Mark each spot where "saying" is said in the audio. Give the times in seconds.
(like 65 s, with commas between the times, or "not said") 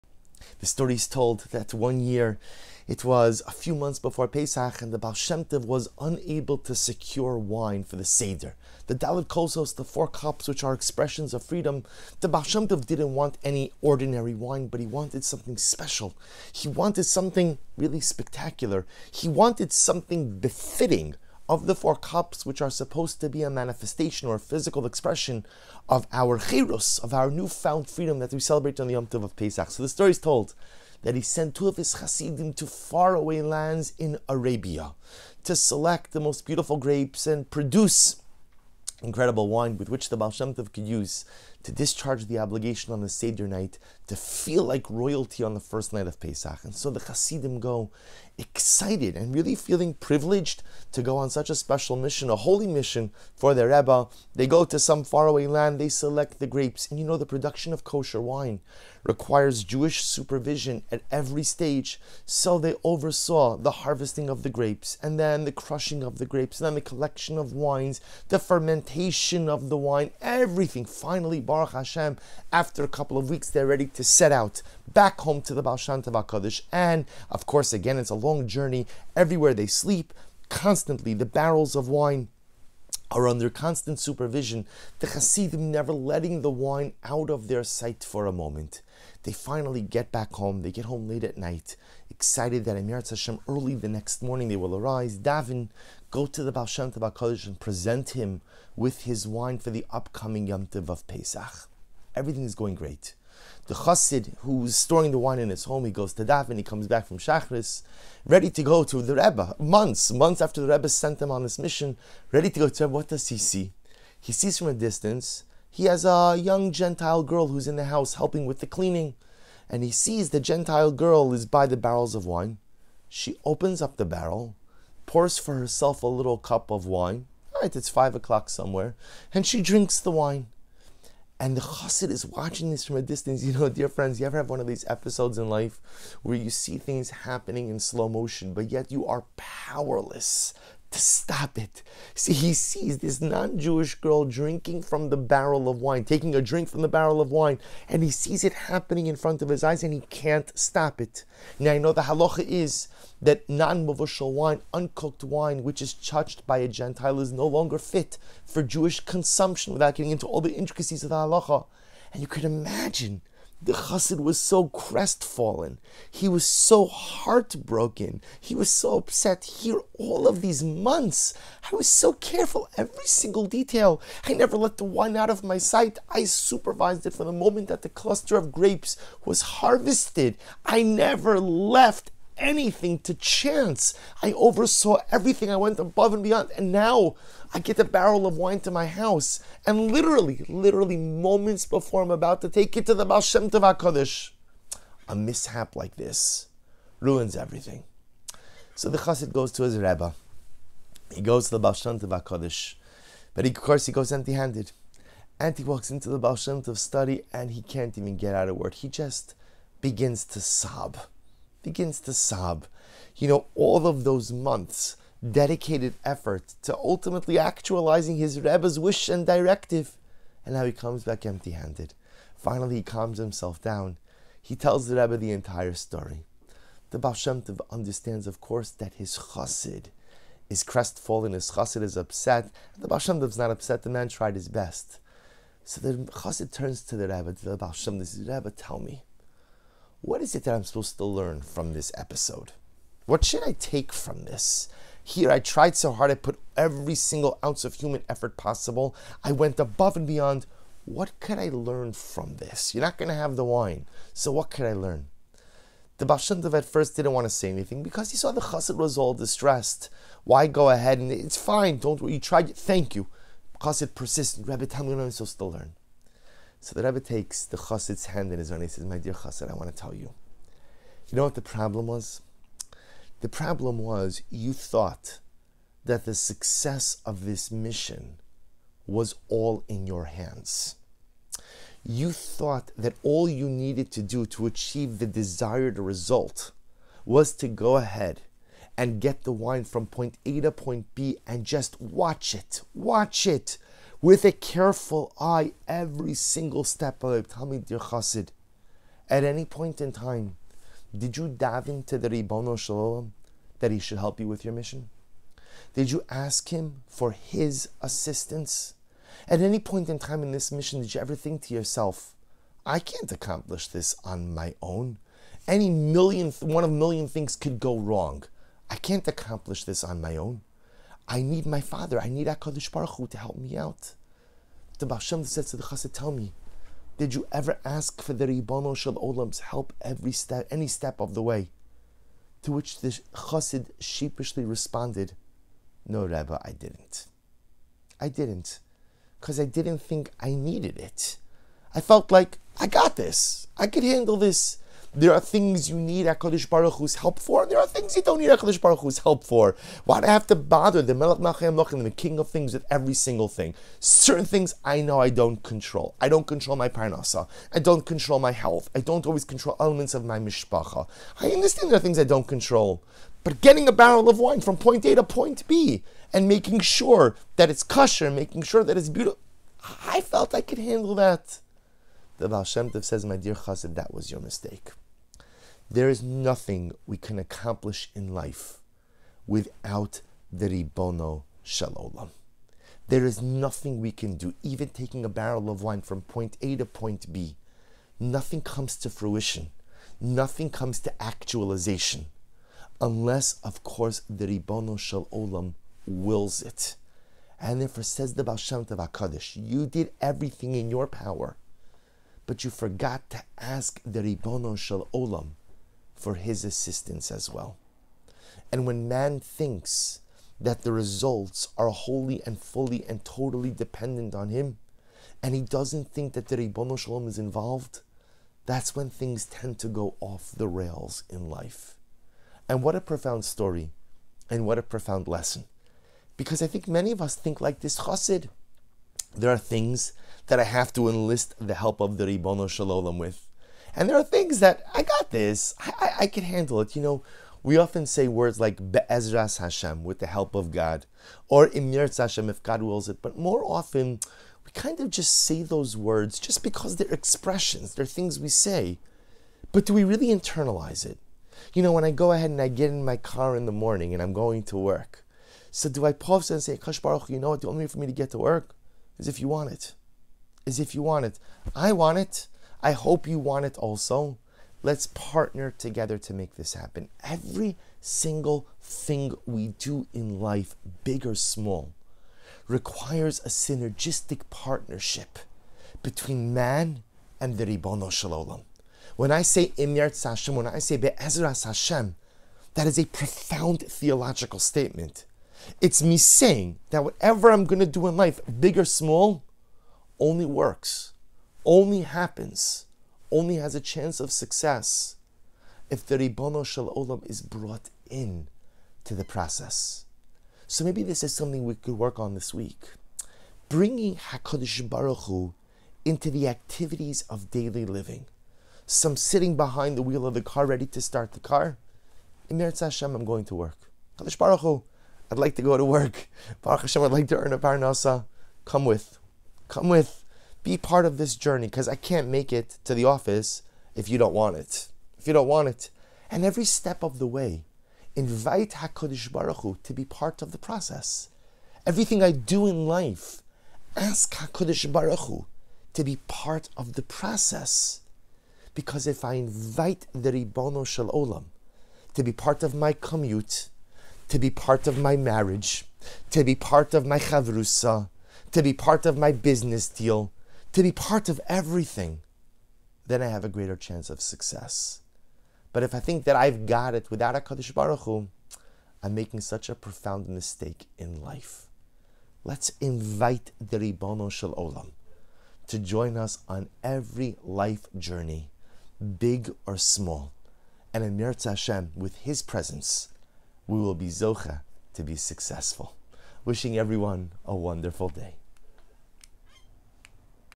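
485 s.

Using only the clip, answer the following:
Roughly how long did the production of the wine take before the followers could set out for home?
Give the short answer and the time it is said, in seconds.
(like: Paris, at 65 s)
A couple of weeks, at 72 s.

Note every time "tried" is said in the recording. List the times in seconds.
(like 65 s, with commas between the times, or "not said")
234 s, 245 s, 262 s.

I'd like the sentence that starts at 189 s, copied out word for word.
And literally, literally moments before I'm about to take it to the Baal Shem Tov HaKadosh, a mishap like this ruins everything.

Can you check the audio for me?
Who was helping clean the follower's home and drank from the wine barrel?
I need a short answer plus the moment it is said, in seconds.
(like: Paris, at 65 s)
A young Gentile girl, at 116 s.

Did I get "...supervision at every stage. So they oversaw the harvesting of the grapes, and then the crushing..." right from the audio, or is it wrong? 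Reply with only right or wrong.
right.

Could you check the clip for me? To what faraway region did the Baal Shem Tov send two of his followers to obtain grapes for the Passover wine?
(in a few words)
Arabia.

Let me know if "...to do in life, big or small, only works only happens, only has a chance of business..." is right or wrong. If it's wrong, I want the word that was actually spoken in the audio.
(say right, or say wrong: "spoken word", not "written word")
wrong: "success", not "business".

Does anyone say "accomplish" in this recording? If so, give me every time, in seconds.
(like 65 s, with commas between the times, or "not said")
313 s, 319 s, 377 s.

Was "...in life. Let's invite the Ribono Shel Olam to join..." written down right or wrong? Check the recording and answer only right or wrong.
right.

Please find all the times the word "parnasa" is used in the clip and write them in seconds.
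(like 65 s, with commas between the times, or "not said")
356 s, 517 s.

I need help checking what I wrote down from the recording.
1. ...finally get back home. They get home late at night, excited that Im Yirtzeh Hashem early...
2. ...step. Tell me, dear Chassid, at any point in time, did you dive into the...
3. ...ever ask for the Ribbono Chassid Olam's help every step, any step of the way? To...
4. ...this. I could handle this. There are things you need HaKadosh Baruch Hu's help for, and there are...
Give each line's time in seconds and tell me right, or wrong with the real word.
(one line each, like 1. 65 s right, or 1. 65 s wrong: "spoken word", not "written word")
1. 89 s right
2. 296 s right
3. 327 s wrong: "Shel", not "Chassid"
4. 342 s right.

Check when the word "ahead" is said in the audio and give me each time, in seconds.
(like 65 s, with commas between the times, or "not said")
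260 s, 287 s, 452 s.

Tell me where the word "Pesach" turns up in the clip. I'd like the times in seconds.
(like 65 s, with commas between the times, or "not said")
4 s, 29 s, 46 s, 101 s.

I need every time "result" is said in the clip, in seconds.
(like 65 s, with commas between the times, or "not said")
285 s, 410 s.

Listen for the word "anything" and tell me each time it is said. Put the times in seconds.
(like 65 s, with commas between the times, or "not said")
182 s, 257 s.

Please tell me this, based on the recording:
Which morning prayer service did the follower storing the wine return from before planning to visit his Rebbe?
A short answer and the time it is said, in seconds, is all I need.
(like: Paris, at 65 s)
Shachris, at 107 s.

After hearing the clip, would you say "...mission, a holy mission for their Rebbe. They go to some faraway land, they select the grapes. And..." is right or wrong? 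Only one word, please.
right.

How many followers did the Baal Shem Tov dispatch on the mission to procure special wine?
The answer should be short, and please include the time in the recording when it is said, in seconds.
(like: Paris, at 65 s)
2, at 31 s.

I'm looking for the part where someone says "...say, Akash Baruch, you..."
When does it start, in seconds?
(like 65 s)
456 s.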